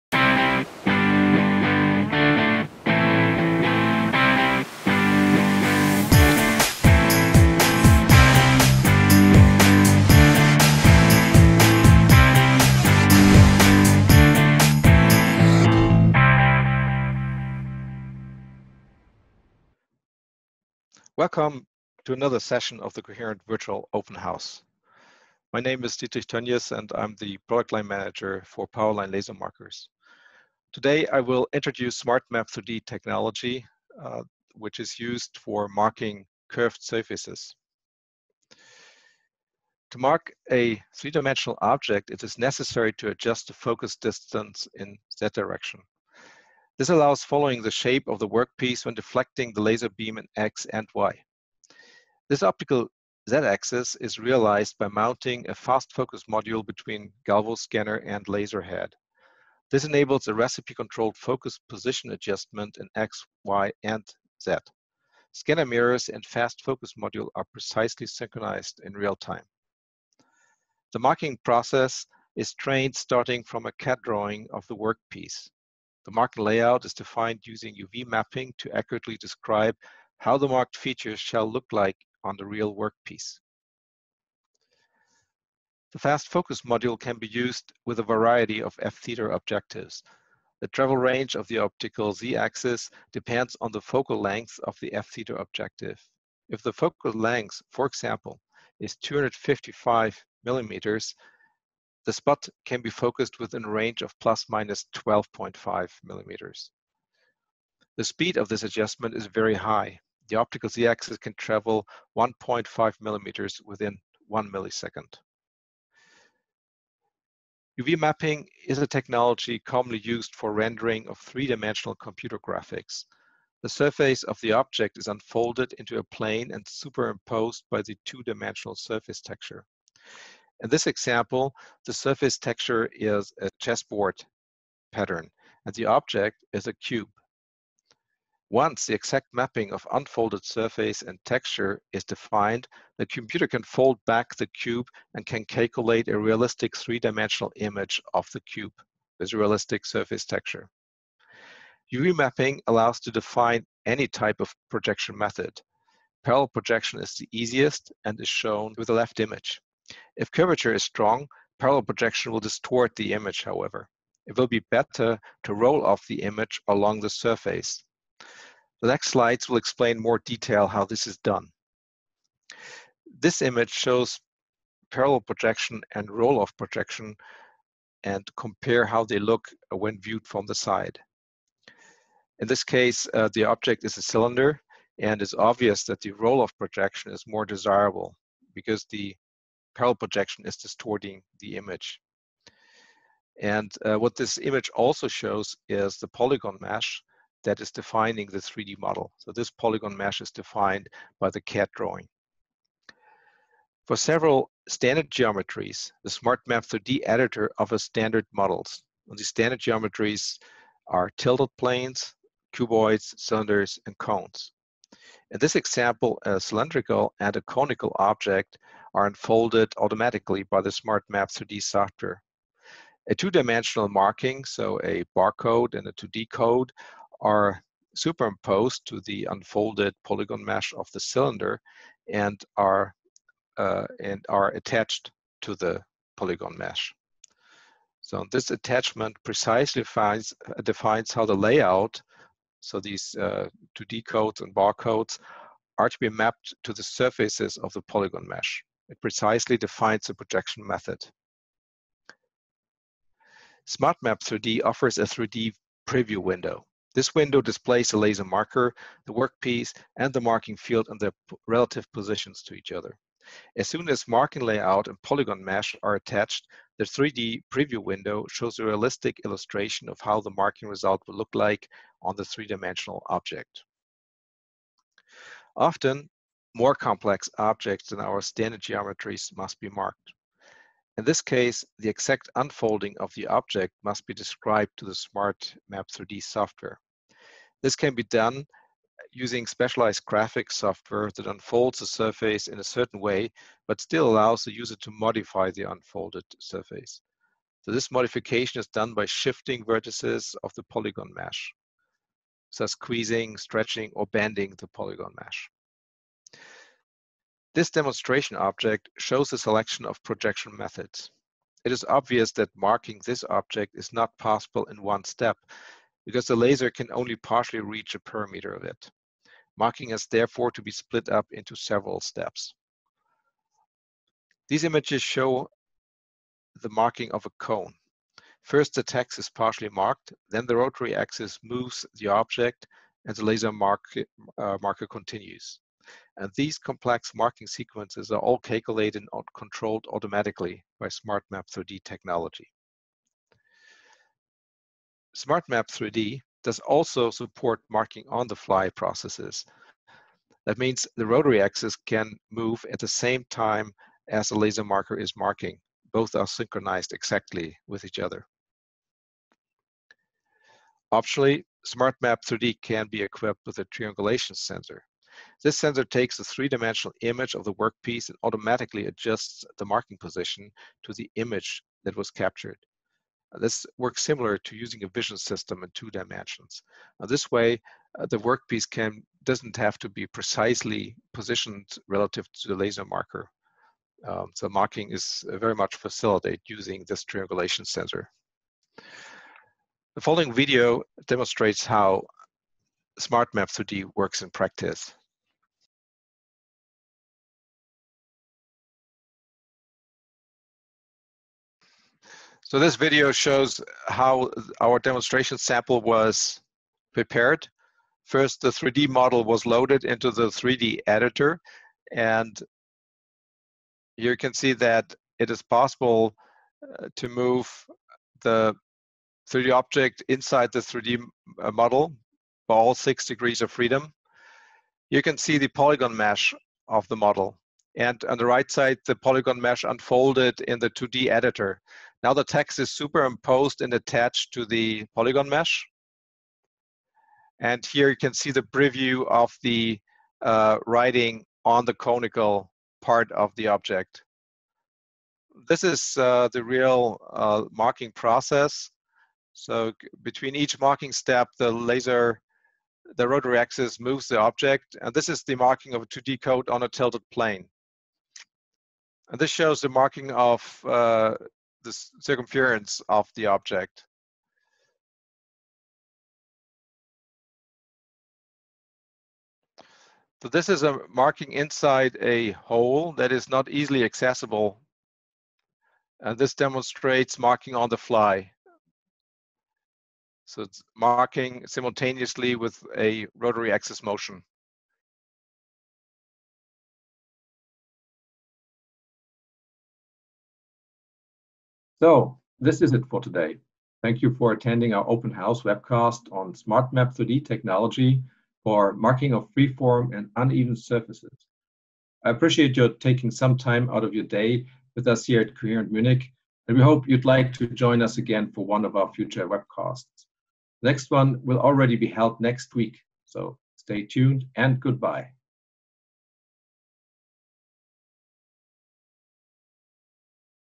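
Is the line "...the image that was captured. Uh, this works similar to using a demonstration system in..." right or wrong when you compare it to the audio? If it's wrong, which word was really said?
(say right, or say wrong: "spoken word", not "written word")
wrong: "vision", not "demonstration".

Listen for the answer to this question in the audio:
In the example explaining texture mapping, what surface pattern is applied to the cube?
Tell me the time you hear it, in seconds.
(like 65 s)
133 s.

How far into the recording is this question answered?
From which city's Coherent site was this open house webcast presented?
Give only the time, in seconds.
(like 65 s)
505 s.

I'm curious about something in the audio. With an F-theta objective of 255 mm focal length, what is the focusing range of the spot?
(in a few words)
±12.5 mm.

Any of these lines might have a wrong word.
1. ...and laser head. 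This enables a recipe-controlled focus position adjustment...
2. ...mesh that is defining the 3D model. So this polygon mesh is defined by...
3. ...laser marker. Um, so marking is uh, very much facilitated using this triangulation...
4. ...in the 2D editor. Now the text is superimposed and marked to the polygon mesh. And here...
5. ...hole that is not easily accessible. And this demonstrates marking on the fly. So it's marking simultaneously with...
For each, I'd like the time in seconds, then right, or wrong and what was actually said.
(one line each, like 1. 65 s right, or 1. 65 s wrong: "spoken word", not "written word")
1. 57 s right
2. 196 s right
3. 382 s right
4. 430 s wrong: "attached", not "marked"
5. 472 s right.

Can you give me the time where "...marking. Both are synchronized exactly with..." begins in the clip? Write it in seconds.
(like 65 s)
355 s.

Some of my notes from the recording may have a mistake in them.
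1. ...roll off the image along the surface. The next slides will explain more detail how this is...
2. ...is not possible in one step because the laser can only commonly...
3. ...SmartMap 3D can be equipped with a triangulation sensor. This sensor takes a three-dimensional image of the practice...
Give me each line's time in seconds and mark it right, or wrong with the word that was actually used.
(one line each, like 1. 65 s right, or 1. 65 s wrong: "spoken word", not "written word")
1. 165 s right
2. 313 s wrong: "partially", not "commonly"
3. 361 s wrong: "workpiece", not "practice".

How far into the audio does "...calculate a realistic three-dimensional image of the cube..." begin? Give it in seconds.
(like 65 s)
145 s.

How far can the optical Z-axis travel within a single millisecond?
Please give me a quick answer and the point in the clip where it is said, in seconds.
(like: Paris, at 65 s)
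1.5 mm, at 112 s.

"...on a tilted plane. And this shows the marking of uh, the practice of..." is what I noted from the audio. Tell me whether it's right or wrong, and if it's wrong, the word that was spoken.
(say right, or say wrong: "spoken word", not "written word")
wrong: "circumference", not "practice".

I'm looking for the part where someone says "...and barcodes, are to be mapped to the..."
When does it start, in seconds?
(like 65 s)
244 s.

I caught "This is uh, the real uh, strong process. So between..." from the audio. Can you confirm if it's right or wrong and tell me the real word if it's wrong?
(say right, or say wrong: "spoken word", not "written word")
wrong: "marking", not "strong".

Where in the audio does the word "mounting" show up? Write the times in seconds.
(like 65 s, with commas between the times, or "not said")
54 s.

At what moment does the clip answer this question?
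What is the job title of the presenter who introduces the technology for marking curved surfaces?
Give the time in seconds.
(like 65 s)
27 s.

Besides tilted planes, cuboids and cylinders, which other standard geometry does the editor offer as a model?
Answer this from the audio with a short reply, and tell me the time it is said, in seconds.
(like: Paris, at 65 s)
cones, at 213 s.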